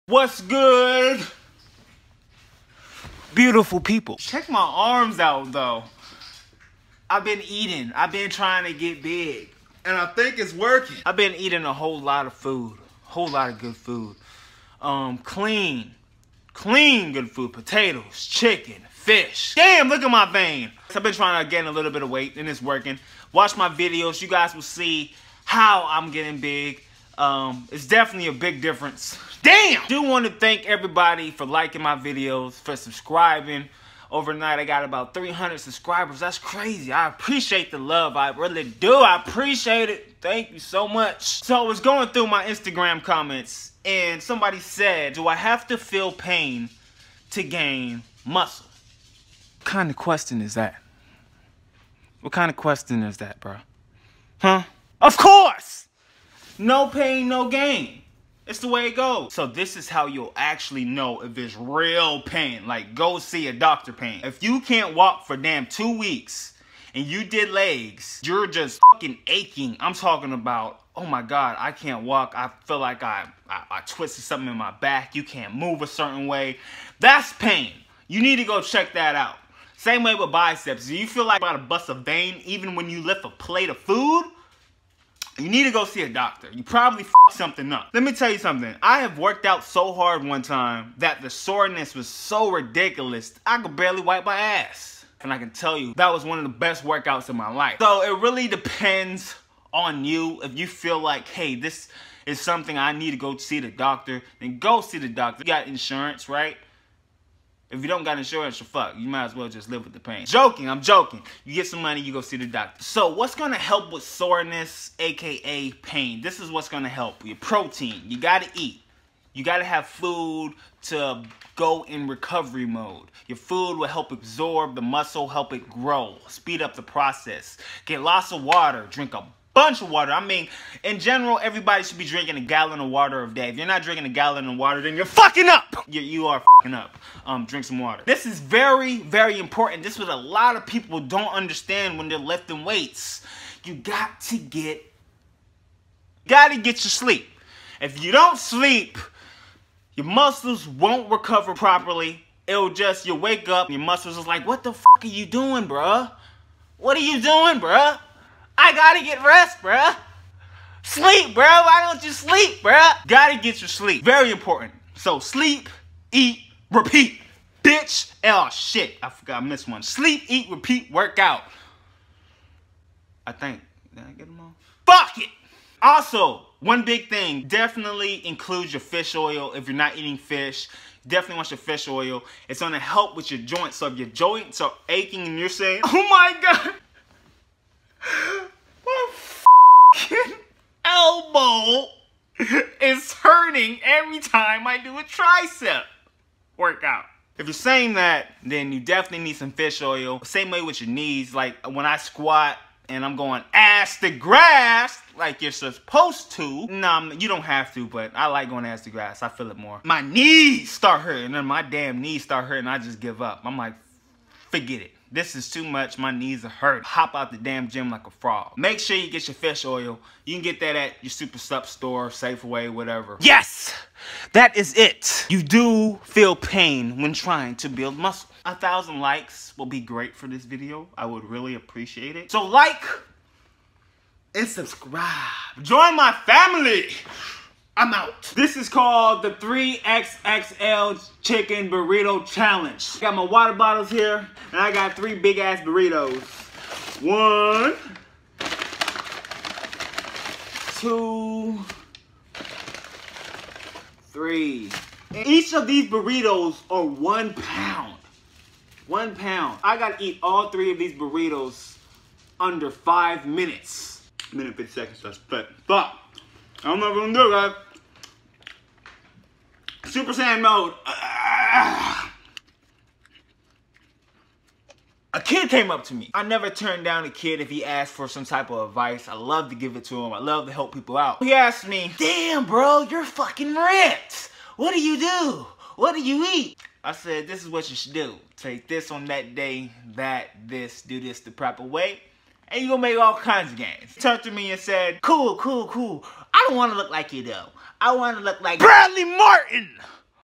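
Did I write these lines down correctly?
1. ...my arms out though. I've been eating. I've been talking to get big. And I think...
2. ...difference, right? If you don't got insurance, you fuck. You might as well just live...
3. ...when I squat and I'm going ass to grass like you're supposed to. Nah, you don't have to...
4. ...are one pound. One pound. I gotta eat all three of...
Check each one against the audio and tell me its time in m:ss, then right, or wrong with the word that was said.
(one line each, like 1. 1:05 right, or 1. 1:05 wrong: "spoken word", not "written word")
1. 0:04 wrong: "trying", not "talking"
2. 1:45 wrong: "insurance", not "difference"
3. 3:21 right
4. 4:16 right.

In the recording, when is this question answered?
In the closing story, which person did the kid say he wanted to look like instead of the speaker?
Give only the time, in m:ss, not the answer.
4:58.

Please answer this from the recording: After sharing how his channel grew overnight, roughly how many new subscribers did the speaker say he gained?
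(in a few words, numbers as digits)
300.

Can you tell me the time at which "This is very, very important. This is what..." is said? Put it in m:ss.
2:18.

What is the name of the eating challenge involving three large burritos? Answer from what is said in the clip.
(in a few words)
3XXL Chicken Burrito Challenge.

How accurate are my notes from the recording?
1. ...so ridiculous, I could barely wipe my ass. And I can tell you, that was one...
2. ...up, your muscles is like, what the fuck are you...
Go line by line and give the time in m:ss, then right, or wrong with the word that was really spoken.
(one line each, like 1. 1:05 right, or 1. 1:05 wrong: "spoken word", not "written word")
1. 1:32 right
2. 2:33 right.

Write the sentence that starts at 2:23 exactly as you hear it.
You got to get, gotta get your sleep.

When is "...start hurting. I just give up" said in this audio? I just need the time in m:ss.
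3:32.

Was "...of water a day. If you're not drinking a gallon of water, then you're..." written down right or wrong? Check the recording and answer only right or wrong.
right.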